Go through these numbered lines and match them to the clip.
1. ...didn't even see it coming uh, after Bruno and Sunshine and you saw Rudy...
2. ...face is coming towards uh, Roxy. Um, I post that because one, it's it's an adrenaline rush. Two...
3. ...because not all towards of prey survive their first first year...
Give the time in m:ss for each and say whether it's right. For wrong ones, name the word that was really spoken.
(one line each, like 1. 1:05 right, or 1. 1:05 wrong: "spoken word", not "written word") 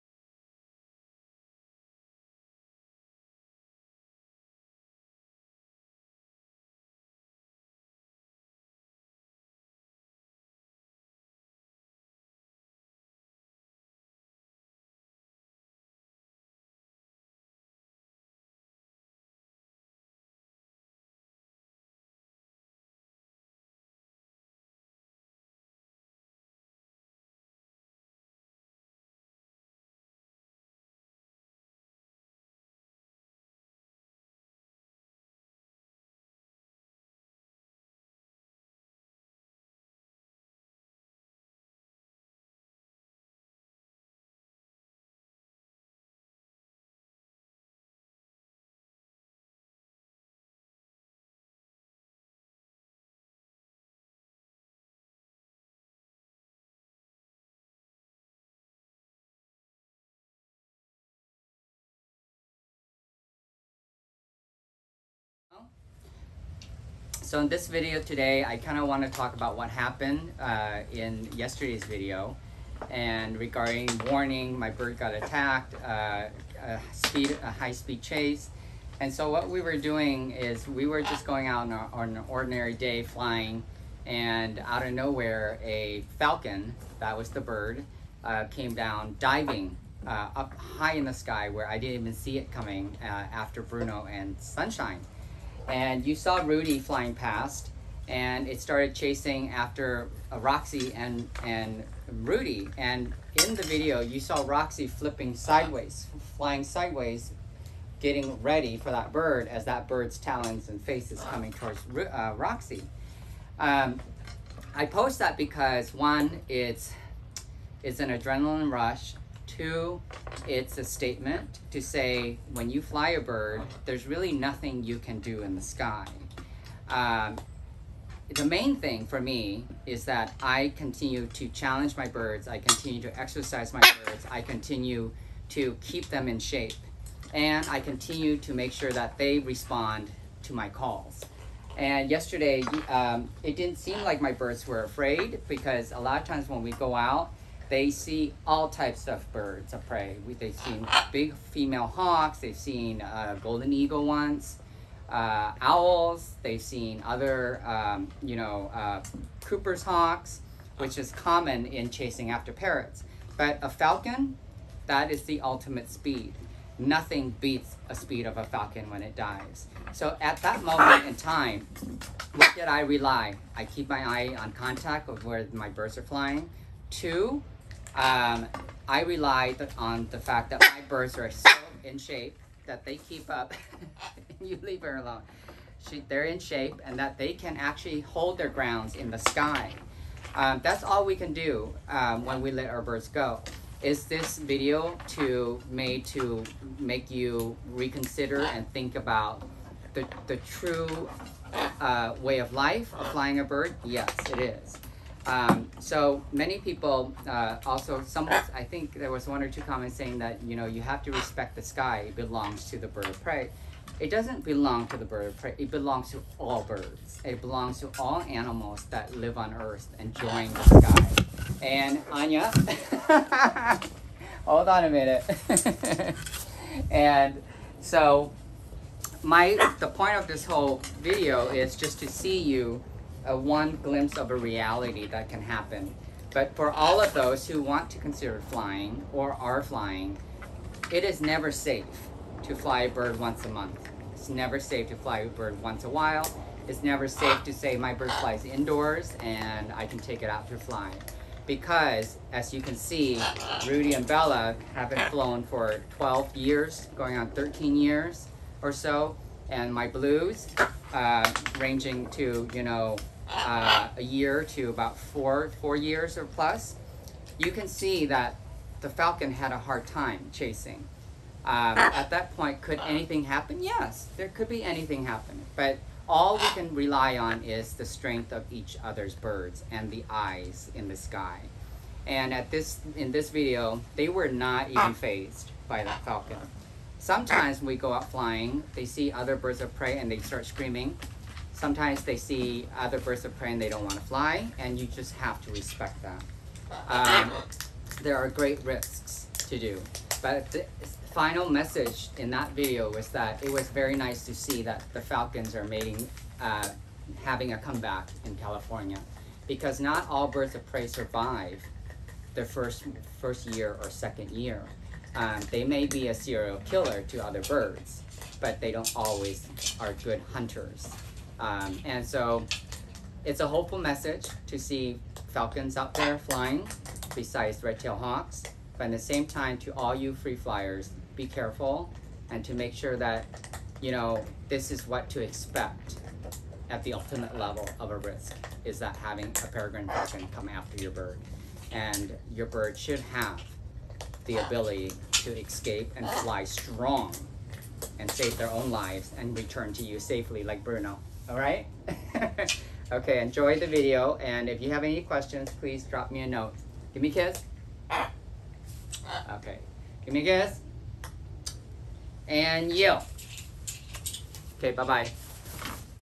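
1. 1:31 right
2. 1:50 right
3. 5:09 wrong: "birds", not "towards".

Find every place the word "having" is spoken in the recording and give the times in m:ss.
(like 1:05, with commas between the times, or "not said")
5:07, 5:38.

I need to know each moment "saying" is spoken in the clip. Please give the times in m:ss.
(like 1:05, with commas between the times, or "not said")
3:29.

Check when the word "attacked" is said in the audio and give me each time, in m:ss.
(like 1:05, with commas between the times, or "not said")
1:15.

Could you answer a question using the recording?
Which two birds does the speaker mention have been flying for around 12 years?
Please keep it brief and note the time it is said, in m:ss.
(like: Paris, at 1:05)
Rudy and Bella, at 4:13.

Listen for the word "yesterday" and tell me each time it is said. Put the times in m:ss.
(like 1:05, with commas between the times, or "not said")
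1:11, 2:22.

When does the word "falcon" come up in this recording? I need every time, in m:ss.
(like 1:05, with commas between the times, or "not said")
1:26, 2:43, 2:48, 4:28, 4:46, 5:05, 5:25, 5:39.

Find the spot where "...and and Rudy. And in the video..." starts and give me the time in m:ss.
1:40.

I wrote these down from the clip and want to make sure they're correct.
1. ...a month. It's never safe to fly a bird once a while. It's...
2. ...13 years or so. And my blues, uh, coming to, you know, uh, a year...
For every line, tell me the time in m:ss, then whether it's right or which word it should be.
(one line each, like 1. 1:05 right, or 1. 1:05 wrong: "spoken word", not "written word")
1. 4:03 right
2. 4:17 wrong: "ranging", not "coming".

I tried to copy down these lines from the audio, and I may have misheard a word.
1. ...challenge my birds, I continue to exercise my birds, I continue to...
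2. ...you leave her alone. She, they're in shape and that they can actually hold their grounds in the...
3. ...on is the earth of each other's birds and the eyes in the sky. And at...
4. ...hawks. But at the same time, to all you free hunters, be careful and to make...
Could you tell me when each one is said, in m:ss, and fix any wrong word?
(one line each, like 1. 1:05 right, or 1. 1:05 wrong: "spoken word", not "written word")
1. 2:11 right
2. 3:04 right
3. 4:37 wrong: "strength", not "earth"
4. 5:27 wrong: "flyers", not "hunters".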